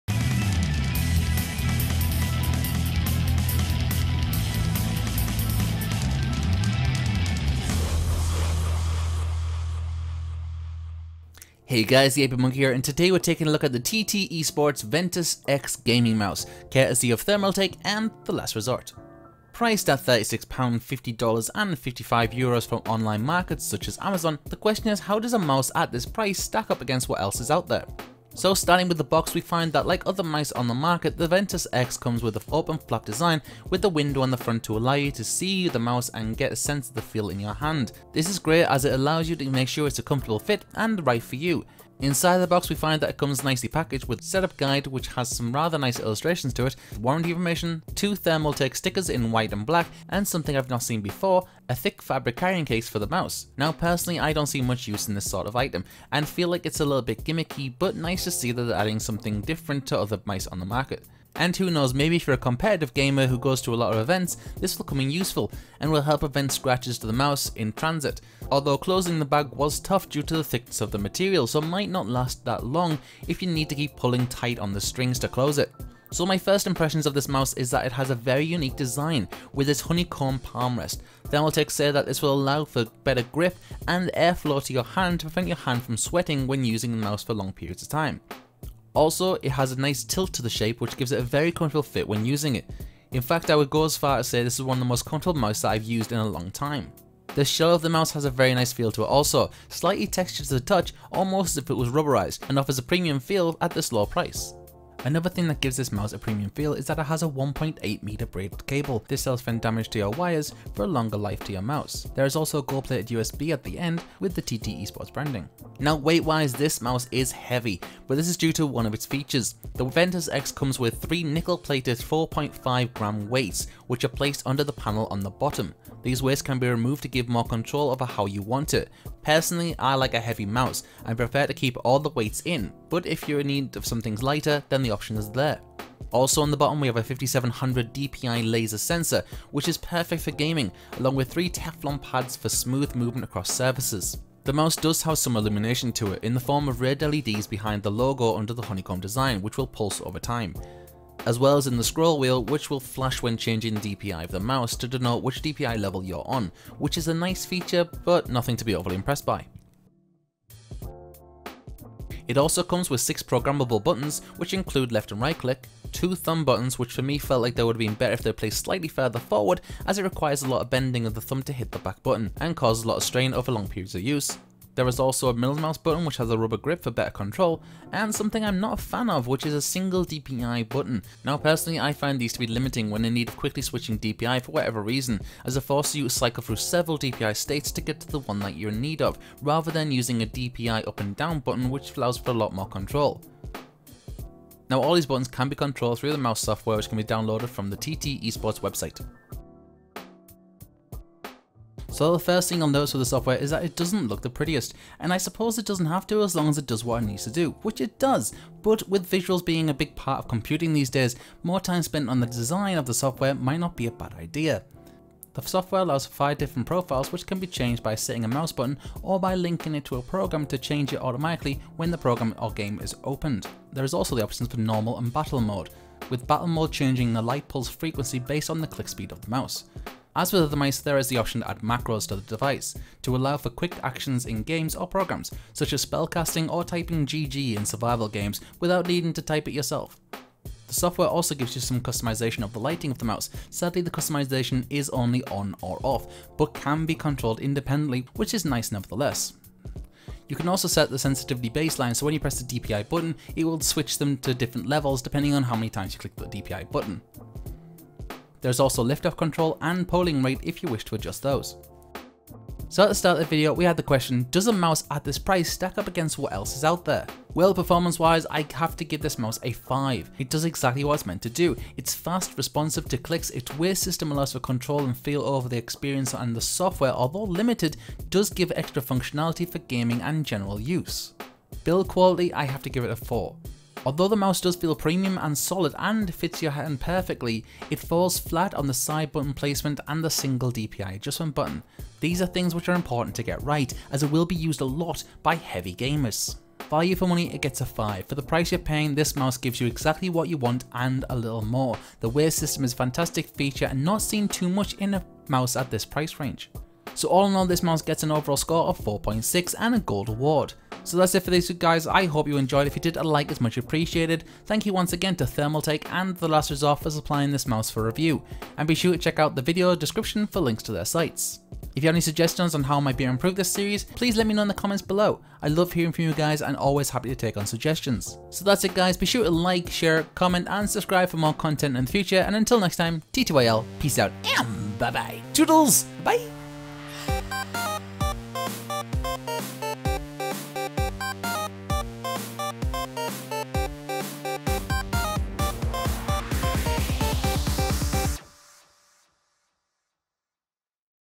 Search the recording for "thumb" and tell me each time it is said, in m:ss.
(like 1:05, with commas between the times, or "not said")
2:46, 2:51.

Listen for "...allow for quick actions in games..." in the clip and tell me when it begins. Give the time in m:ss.
3:53.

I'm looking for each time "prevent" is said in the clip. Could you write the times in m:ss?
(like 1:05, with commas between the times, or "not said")
1:06, 1:25.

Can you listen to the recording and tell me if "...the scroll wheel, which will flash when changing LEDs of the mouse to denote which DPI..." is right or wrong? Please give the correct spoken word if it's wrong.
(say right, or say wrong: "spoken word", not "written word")
wrong: "DPI", not "LEDs".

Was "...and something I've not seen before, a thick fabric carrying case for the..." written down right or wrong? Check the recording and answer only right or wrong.
right.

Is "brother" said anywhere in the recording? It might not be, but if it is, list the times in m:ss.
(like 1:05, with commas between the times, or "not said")
not said.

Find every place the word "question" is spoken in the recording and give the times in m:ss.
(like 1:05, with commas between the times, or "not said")
0:24, 4:23.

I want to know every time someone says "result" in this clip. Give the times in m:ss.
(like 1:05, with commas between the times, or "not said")
not said.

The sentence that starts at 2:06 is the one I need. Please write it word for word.
These weights can be removed to give more control over how you want it.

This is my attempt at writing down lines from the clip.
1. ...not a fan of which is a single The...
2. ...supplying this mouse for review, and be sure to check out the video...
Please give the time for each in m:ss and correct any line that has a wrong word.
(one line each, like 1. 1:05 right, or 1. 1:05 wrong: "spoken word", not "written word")
1. 2:58 wrong: "DPI", not "The"
2. 5:16 right.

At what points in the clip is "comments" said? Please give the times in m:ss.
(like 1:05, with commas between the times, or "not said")
5:24, 5:30.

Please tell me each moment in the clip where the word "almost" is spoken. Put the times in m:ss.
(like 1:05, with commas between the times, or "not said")
1:41.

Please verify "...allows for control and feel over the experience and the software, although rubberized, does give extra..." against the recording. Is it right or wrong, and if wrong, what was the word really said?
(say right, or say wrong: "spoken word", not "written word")
wrong: "limited", not "rubberized".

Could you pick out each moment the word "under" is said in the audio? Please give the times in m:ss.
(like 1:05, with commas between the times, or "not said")
2:04, 2:28.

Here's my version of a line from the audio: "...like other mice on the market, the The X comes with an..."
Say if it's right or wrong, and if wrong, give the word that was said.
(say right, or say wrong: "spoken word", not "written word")
wrong: "Ventus", not "The".